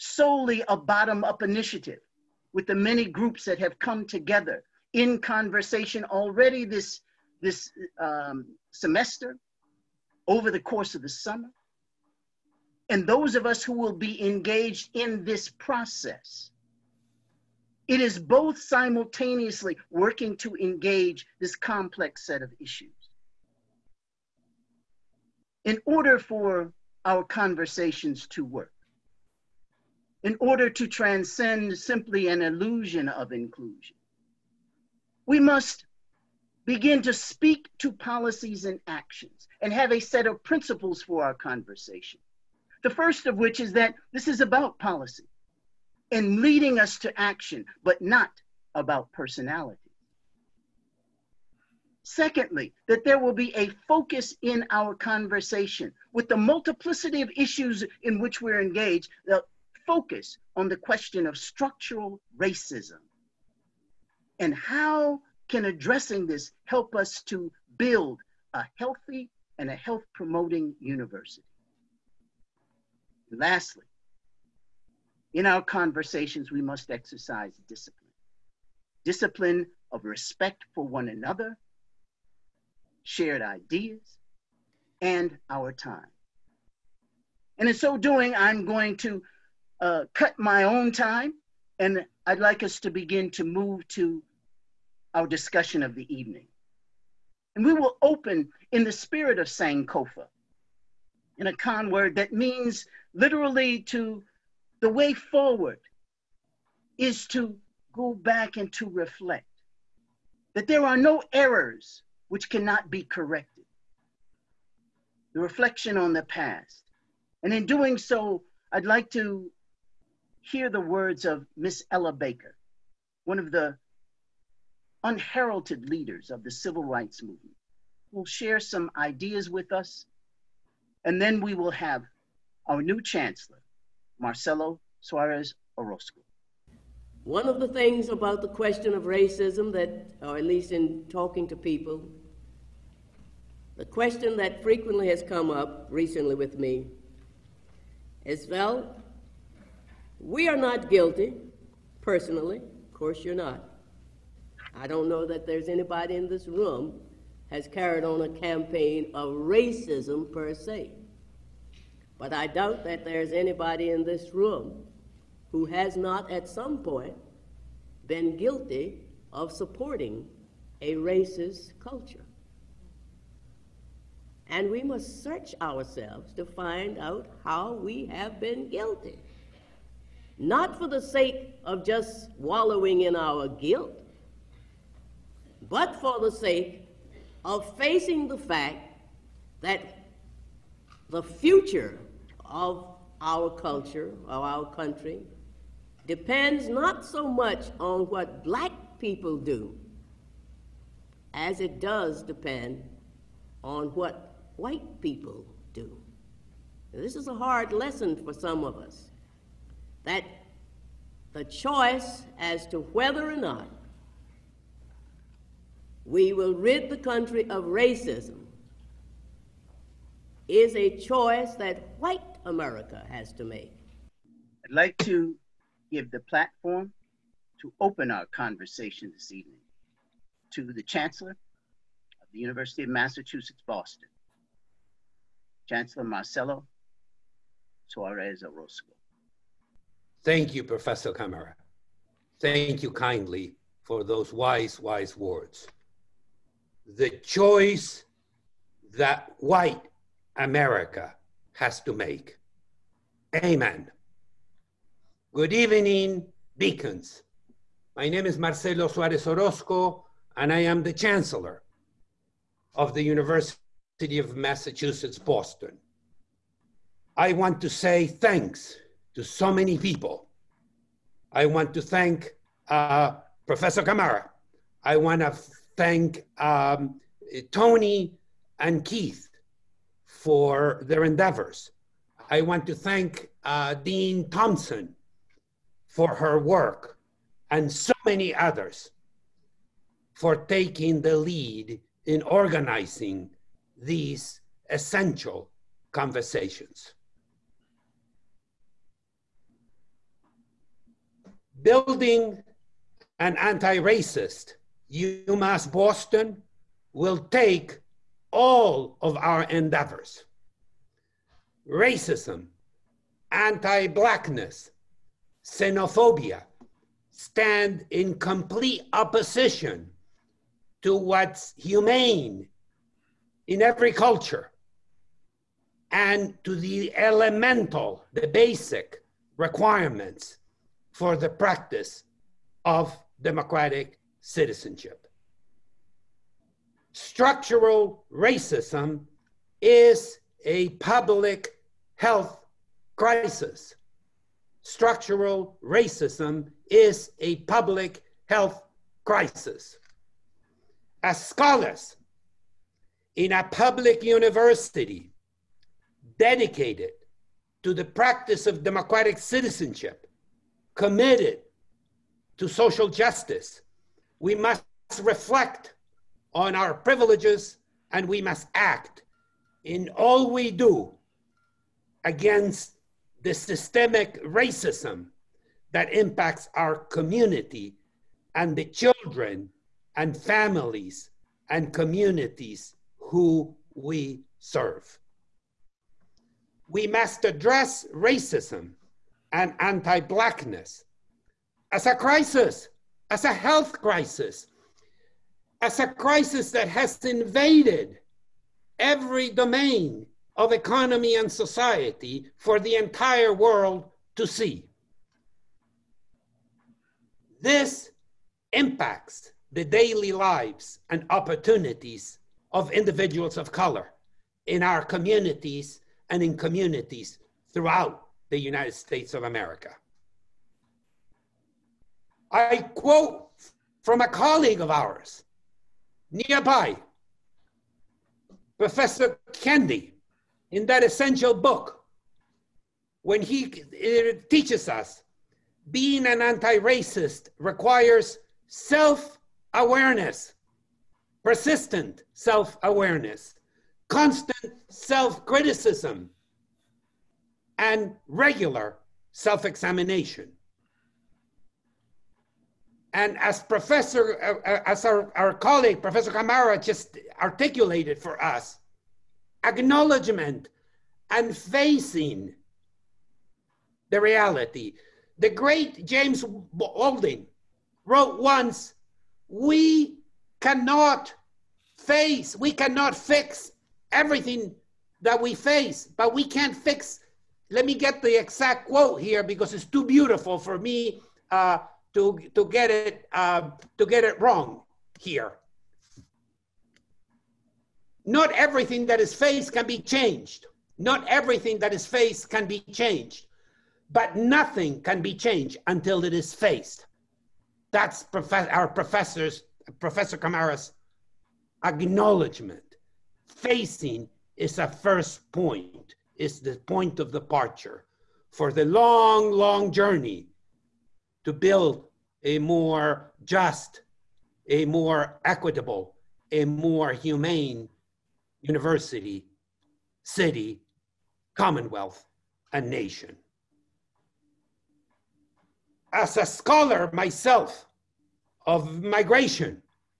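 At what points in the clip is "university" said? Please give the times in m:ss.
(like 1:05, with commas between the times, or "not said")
1:10, 3:52, 4:23, 5:54, 8:38.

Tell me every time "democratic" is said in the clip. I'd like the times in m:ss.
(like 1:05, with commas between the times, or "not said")
5:33, 5:58.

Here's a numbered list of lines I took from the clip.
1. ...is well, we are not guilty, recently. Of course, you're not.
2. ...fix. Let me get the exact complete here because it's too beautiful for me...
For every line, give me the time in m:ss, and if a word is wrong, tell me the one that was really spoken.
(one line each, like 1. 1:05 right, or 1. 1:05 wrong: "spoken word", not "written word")
1. 2:28 wrong: "personally", not "recently"
2. 7:56 wrong: "quote", not "complete".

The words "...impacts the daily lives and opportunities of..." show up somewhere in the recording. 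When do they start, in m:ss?
6:48.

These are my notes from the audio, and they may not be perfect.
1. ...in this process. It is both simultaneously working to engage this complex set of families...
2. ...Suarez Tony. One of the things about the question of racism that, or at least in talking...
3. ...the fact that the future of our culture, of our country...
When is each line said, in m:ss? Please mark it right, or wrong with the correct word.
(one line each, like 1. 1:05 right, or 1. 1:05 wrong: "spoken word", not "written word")
1. 0:14 wrong: "issues", not "families"
2. 2:14 wrong: "Orozco", not "Tony"
3. 3:08 right.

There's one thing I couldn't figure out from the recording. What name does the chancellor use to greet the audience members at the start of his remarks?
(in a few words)
Beacons.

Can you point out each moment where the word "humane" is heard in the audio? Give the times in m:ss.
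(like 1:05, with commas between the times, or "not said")
5:21, 8:36.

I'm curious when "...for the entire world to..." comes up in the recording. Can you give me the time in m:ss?
6:42.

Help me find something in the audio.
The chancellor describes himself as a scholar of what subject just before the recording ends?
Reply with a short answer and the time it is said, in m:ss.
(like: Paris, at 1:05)
Migration, at 8:48.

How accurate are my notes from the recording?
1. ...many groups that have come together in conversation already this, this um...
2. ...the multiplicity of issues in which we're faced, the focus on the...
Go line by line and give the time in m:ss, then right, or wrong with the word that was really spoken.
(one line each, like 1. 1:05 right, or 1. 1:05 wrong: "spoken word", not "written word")
1. 0:02 right
2. 0:56 wrong: "engaged", not "faced".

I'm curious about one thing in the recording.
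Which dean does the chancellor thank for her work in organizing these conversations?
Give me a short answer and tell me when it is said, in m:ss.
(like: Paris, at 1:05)
Dean Thompson, at 4:43.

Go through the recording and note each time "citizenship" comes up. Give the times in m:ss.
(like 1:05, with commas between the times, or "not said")
5:34, 5:59.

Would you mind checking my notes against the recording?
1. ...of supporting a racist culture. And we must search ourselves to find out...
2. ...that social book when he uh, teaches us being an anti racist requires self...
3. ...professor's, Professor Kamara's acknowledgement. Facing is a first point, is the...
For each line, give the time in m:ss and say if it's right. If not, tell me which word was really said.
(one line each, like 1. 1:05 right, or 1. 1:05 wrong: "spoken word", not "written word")
1. 2:49 right
2. 7:10 wrong: "essential", not "social"
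3. 8:18 right.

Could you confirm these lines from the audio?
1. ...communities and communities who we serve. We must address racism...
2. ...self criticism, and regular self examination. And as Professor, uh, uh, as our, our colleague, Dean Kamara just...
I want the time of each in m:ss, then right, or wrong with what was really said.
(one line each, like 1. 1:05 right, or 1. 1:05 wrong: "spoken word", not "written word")
1. 6:20 wrong: "families", not "communities"
2. 7:24 wrong: "Professor", not "Dean".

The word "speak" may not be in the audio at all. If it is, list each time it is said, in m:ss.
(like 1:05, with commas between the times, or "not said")
0:37.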